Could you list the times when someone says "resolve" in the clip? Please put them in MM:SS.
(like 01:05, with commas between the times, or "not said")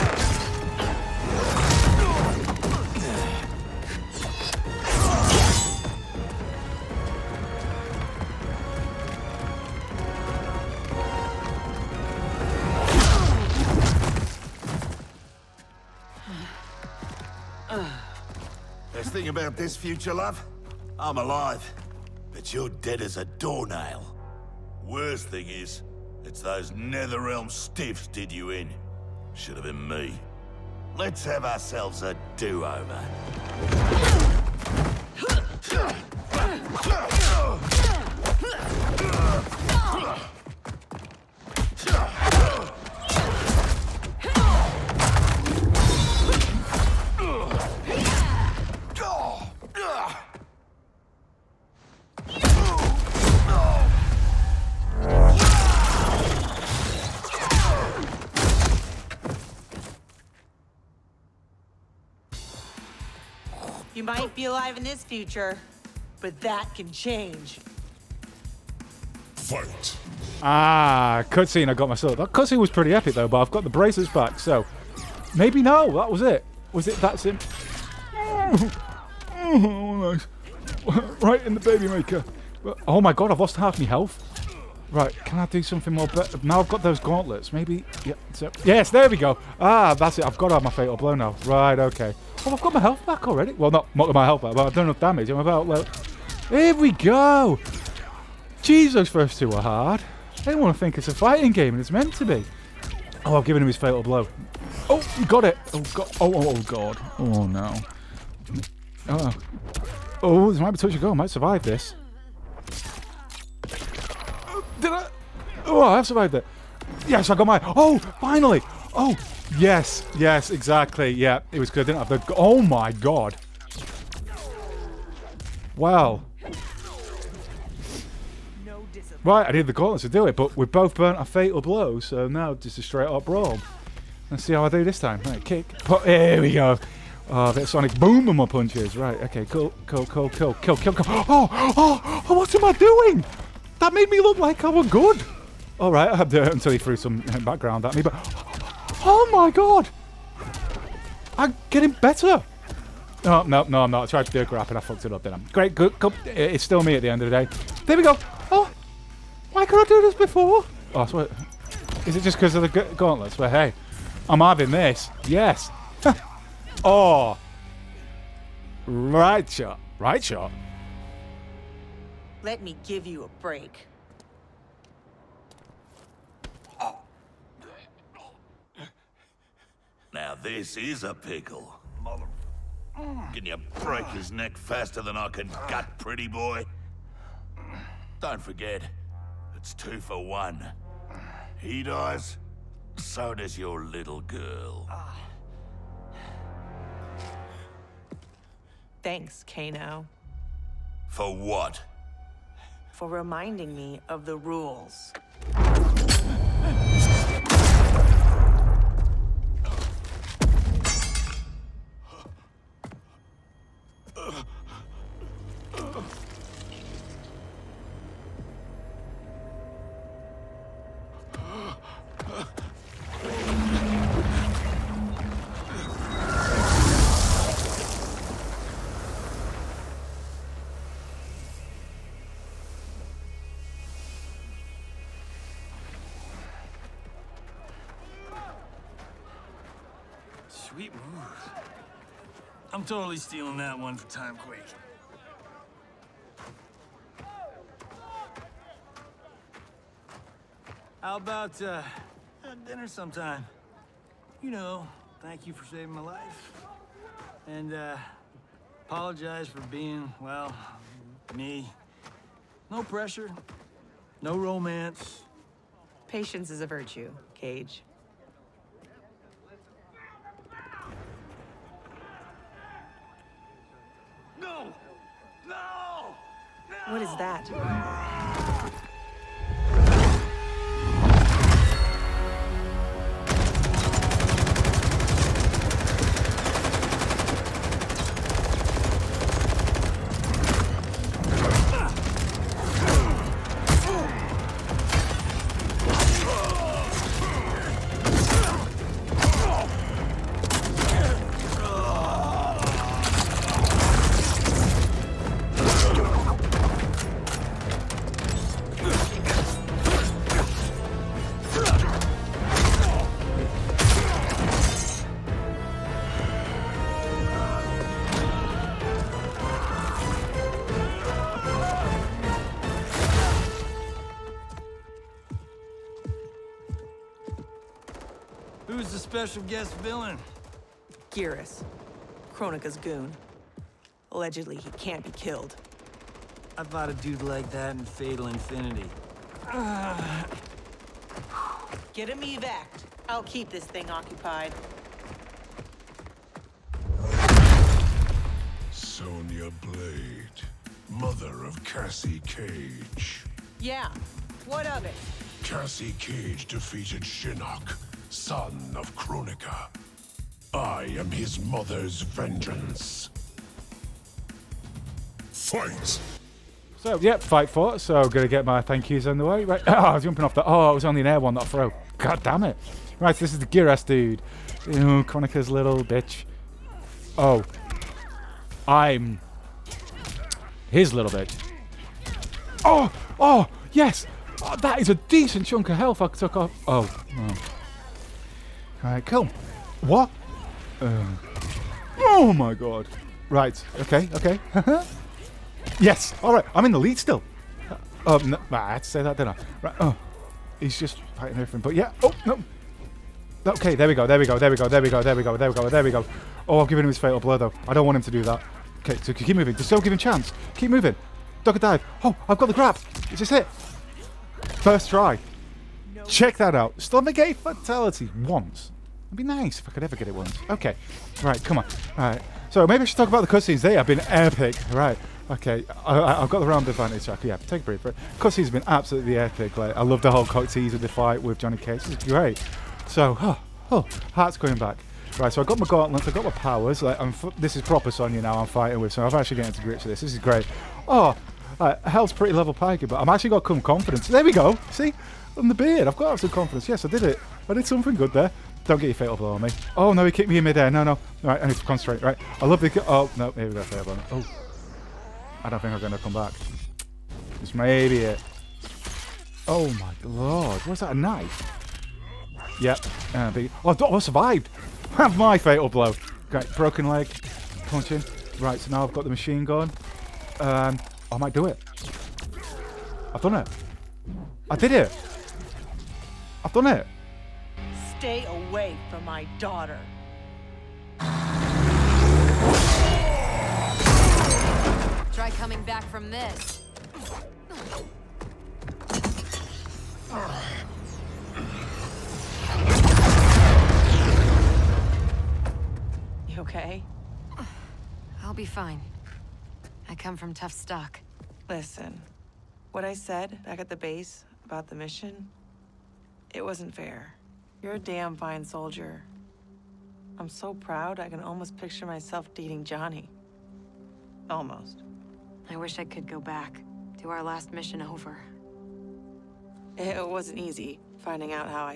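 not said.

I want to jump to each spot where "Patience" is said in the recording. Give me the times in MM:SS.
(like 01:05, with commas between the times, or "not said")
04:26.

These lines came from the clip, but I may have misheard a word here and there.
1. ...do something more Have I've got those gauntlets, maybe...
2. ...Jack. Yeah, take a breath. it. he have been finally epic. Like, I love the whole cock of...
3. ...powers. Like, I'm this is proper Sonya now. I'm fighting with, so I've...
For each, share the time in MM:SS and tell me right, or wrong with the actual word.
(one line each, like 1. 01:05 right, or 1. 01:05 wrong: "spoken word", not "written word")
1. 01:25 wrong: "Now", not "Have"
2. 07:07 wrong: "absolutely", not "finally"
3. 07:16 right.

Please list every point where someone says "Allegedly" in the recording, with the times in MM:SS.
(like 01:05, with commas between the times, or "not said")
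05:34.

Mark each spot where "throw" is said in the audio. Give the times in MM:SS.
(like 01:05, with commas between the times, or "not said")
06:11.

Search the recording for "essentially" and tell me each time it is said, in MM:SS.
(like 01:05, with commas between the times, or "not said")
not said.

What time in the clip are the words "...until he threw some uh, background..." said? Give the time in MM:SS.
02:26.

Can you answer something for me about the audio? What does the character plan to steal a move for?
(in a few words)
Timequake.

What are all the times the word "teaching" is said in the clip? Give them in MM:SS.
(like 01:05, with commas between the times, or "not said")
not said.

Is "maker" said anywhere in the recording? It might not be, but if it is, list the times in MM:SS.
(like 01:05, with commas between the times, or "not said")
01:21.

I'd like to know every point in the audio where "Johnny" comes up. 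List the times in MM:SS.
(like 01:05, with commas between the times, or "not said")
07:11, 08:32.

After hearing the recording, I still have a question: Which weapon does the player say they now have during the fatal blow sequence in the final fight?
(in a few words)
machine gun.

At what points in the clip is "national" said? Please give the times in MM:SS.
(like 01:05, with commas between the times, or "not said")
not said.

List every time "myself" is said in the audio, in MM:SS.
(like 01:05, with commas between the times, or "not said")
01:11, 08:31.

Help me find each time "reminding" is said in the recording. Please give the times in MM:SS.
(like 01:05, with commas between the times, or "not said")
03:23.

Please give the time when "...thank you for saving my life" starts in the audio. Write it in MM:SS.
04:15.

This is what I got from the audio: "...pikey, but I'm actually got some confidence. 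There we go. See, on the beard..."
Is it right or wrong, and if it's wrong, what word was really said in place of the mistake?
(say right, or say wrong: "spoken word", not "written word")
right.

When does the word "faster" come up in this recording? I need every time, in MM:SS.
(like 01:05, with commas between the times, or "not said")
03:04.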